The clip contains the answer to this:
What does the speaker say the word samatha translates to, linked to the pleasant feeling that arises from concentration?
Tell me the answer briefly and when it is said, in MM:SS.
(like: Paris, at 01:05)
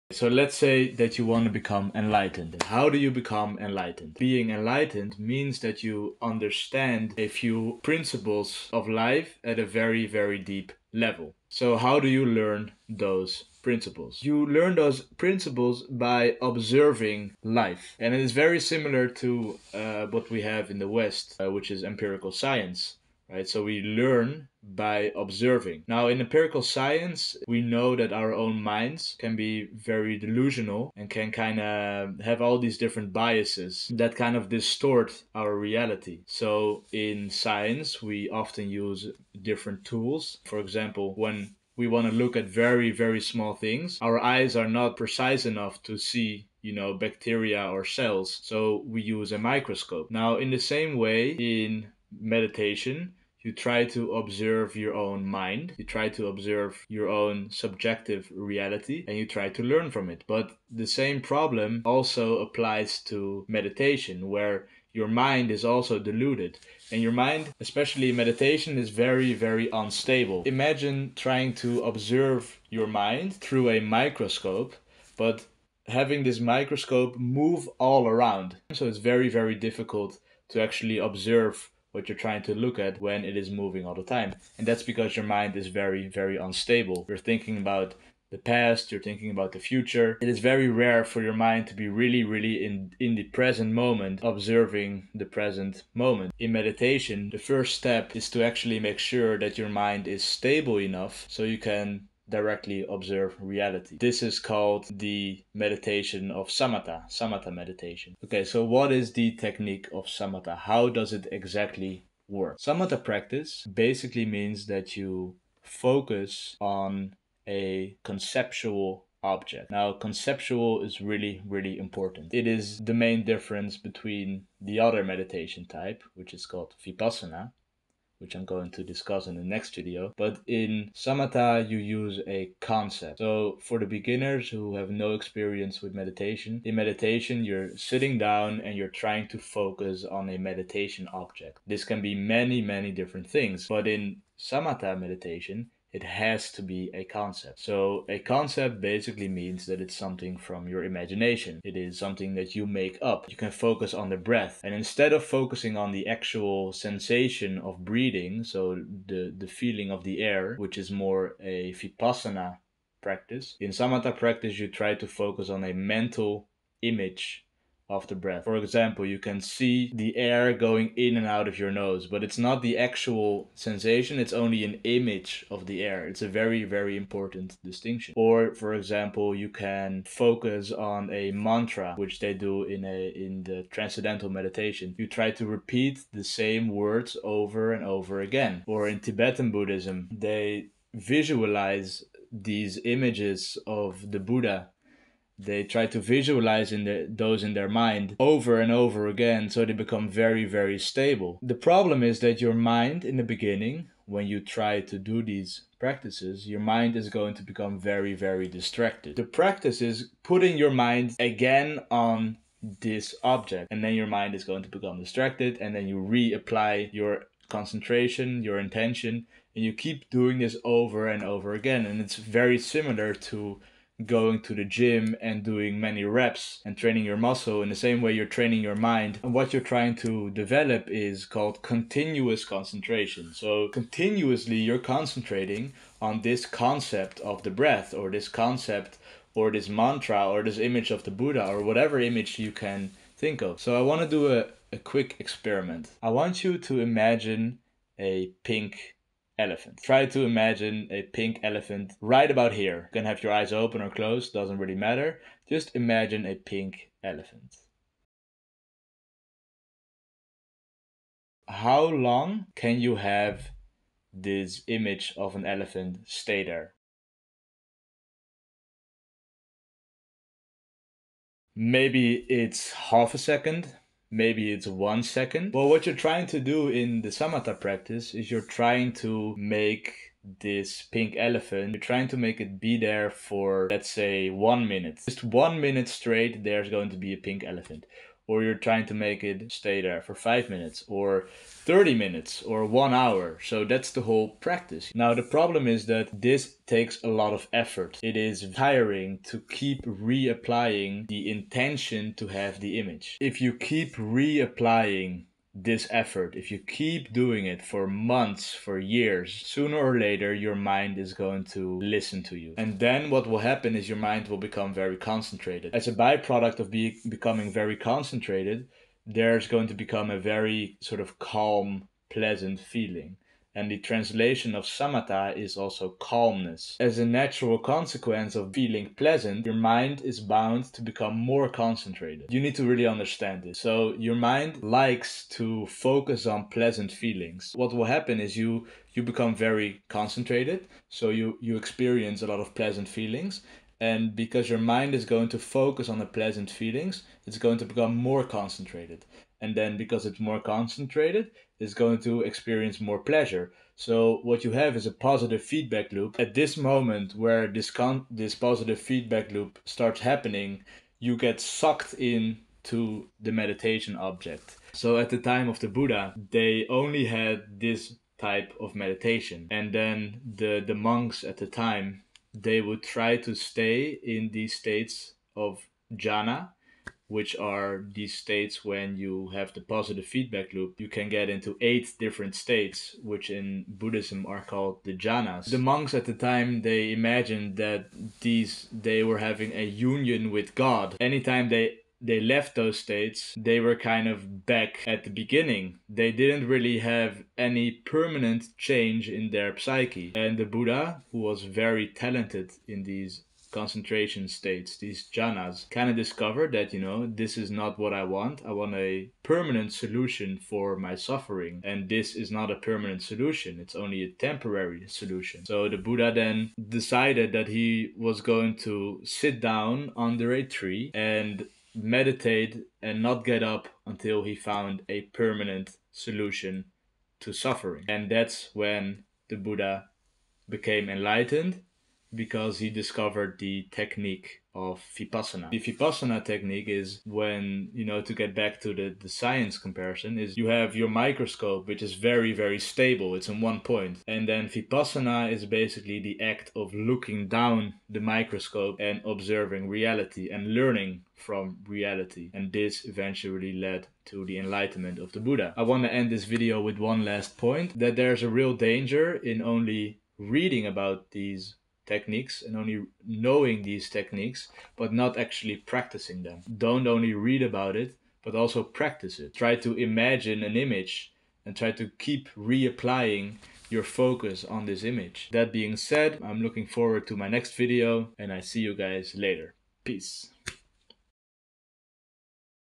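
calmness, at 05:25.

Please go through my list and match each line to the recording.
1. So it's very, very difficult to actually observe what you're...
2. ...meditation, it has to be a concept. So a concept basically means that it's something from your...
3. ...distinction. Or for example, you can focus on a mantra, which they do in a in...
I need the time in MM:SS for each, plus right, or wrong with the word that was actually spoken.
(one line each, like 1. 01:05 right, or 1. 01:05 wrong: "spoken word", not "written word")
1. 01:18 right
2. 02:24 right
3. 02:57 right.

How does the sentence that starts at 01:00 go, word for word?
But the same problem also applies to meditation, where your mind is also deluded.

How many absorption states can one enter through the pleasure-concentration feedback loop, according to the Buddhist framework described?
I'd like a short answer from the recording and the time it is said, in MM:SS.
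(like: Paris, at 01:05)
8, at 06:21.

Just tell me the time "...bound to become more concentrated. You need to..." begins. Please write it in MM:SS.
05:30.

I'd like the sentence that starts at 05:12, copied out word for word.
And then what will happen is your mind will become very concentrated.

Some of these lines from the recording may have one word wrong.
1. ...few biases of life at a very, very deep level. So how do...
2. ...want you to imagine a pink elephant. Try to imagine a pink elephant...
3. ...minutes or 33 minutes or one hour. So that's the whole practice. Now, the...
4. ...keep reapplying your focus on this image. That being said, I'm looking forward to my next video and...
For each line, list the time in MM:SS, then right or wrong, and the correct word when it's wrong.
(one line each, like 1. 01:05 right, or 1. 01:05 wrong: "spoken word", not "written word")
1. 00:07 wrong: "principles", not "biases"
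2. 04:06 right
3. 04:50 wrong: "30", not "33"
4. 07:52 right.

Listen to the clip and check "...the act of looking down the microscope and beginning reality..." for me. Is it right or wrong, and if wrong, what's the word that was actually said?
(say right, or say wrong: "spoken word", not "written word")
wrong: "observing", not "beginning".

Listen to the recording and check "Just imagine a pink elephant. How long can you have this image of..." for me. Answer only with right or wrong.
right.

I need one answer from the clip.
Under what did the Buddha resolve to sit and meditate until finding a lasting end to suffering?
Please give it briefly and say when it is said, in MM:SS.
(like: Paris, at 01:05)
a tree, at 07:00.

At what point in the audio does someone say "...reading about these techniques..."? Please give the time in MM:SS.
07:40.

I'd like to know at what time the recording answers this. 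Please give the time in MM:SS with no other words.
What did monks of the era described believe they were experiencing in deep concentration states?
06:29.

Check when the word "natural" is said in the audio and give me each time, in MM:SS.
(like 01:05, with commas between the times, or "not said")
05:27.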